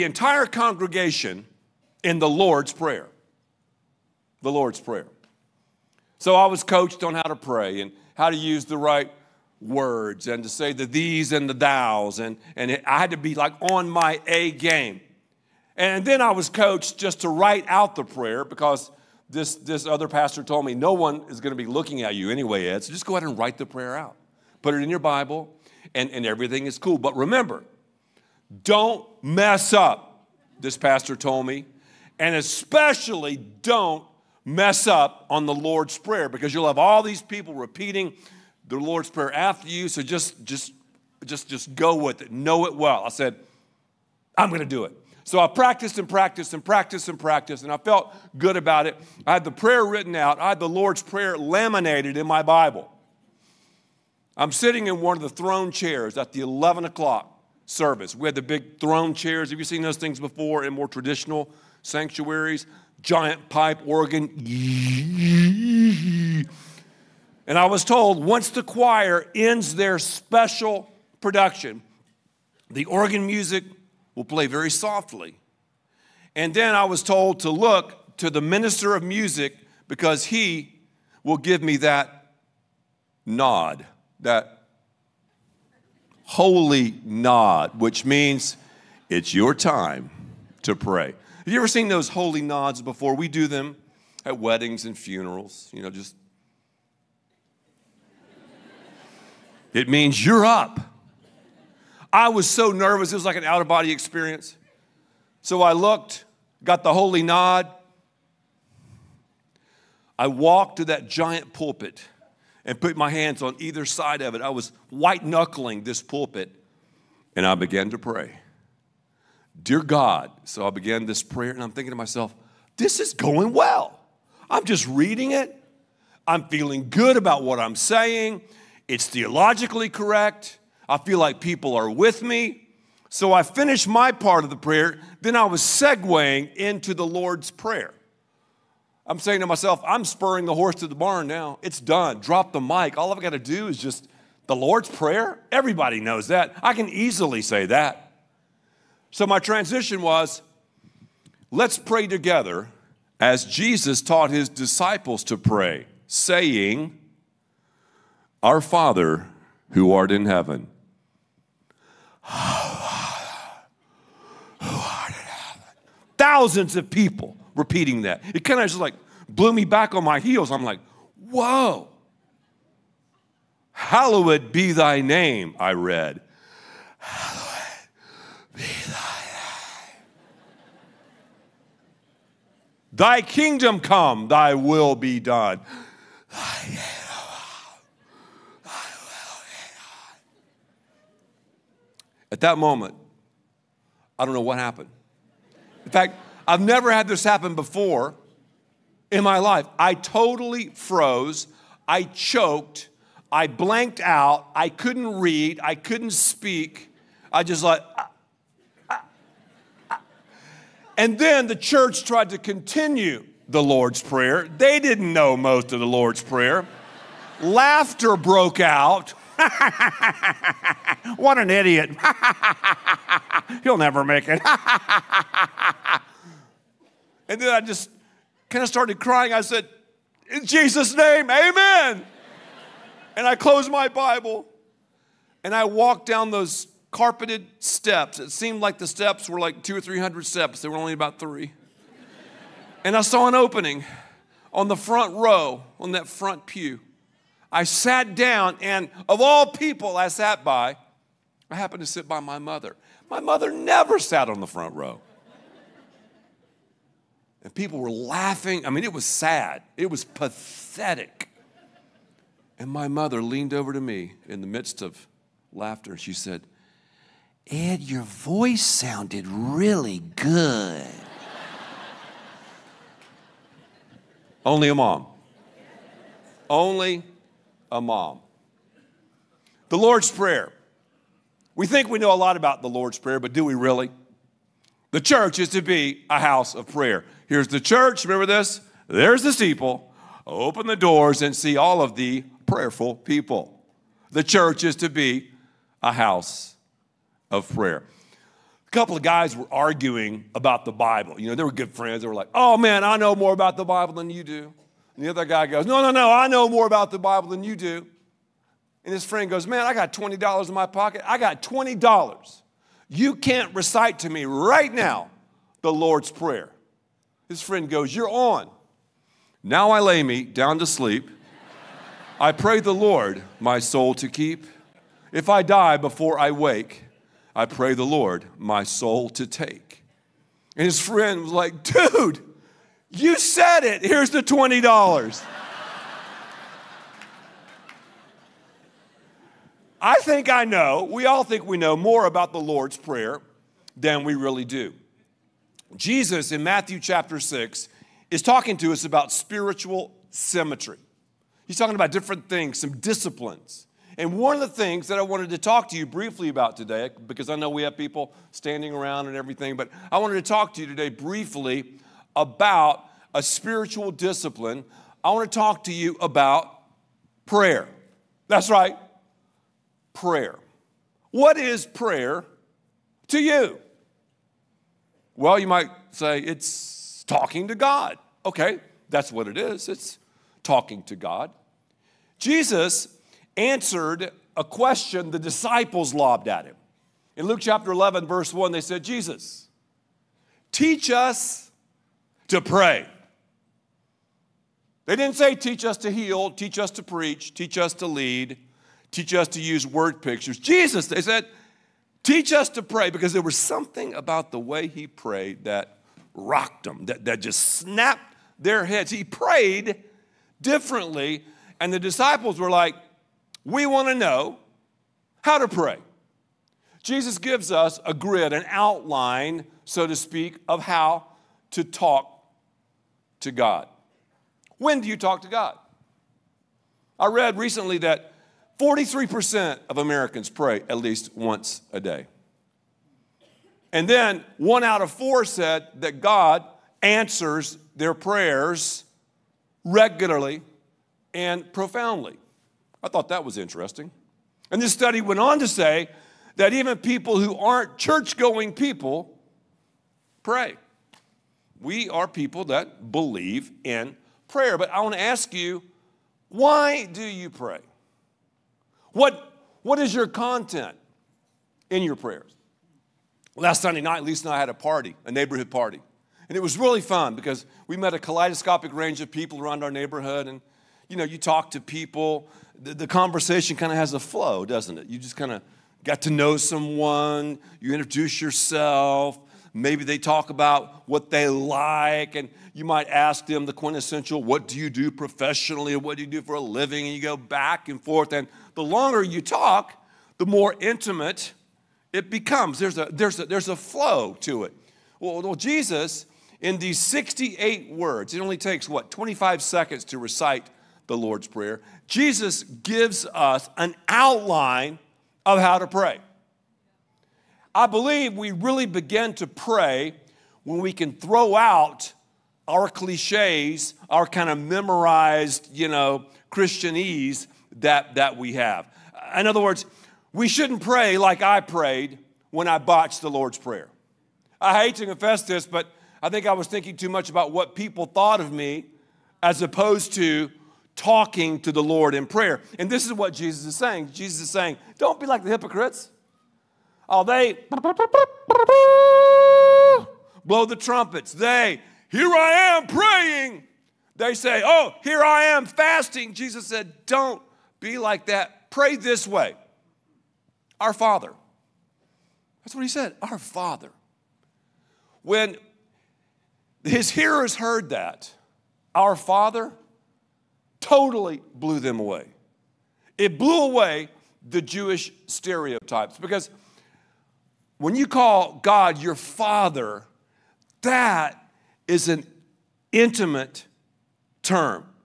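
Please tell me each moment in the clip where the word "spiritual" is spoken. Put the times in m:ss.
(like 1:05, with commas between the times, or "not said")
5:49, 6:03.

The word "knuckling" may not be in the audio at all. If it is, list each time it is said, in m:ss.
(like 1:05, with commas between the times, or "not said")
1:55.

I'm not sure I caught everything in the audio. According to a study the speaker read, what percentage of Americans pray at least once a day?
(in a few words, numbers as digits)
43%.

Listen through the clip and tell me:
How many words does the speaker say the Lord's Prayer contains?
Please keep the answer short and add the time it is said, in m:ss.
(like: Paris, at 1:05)
68, at 8:16.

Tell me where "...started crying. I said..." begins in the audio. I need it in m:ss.
3:48.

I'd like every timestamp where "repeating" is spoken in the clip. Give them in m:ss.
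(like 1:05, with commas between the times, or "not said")
0:37, 2:47.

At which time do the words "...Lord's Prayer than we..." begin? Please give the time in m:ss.
5:42.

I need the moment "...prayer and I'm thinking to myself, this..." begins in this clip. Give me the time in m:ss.
2:01.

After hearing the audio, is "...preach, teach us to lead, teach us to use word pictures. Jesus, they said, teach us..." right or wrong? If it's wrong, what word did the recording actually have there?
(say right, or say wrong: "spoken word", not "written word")
right.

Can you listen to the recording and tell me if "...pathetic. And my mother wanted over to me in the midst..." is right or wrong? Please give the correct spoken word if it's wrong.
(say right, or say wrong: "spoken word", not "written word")
wrong: "leaned", not "wanted".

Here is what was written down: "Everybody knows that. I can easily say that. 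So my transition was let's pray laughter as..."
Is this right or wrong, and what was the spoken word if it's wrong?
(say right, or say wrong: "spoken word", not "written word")
wrong: "together", not "laughter".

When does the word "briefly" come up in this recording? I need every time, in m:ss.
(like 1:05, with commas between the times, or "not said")
5:55, 6:00.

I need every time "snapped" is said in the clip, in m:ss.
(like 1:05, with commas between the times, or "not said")
6:47.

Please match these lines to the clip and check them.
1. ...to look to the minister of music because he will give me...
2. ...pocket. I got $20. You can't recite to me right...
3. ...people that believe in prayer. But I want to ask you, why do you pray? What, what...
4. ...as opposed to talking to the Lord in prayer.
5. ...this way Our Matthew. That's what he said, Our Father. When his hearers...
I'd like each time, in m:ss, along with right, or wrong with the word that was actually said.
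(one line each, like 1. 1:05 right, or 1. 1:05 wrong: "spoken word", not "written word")
1. 1:17 right
2. 5:10 right
3. 7:32 right
4. 8:49 right
5. 9:08 wrong: "Father", not "Matthew".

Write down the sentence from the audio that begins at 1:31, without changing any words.
Have you ever seen those holy nods before?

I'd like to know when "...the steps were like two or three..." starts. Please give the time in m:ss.
3:58.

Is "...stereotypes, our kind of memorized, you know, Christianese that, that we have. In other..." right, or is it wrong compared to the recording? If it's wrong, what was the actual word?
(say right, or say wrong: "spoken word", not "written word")
wrong: "cliches", not "stereotypes".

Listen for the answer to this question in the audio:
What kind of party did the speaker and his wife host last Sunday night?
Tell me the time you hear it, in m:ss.
7:45.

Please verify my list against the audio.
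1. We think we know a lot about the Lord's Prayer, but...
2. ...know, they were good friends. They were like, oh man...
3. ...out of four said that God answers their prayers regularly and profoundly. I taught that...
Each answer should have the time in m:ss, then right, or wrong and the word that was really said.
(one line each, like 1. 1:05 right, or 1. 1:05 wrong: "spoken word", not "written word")
1. 4:41 right
2. 5:01 right
3. 7:14 wrong: "thought", not "taught".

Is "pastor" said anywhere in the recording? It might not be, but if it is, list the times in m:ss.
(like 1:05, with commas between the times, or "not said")
0:20, 0:30.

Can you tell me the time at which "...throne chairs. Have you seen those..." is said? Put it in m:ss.
0:58.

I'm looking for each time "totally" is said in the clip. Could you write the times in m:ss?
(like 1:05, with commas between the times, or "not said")
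3:19, 9:20.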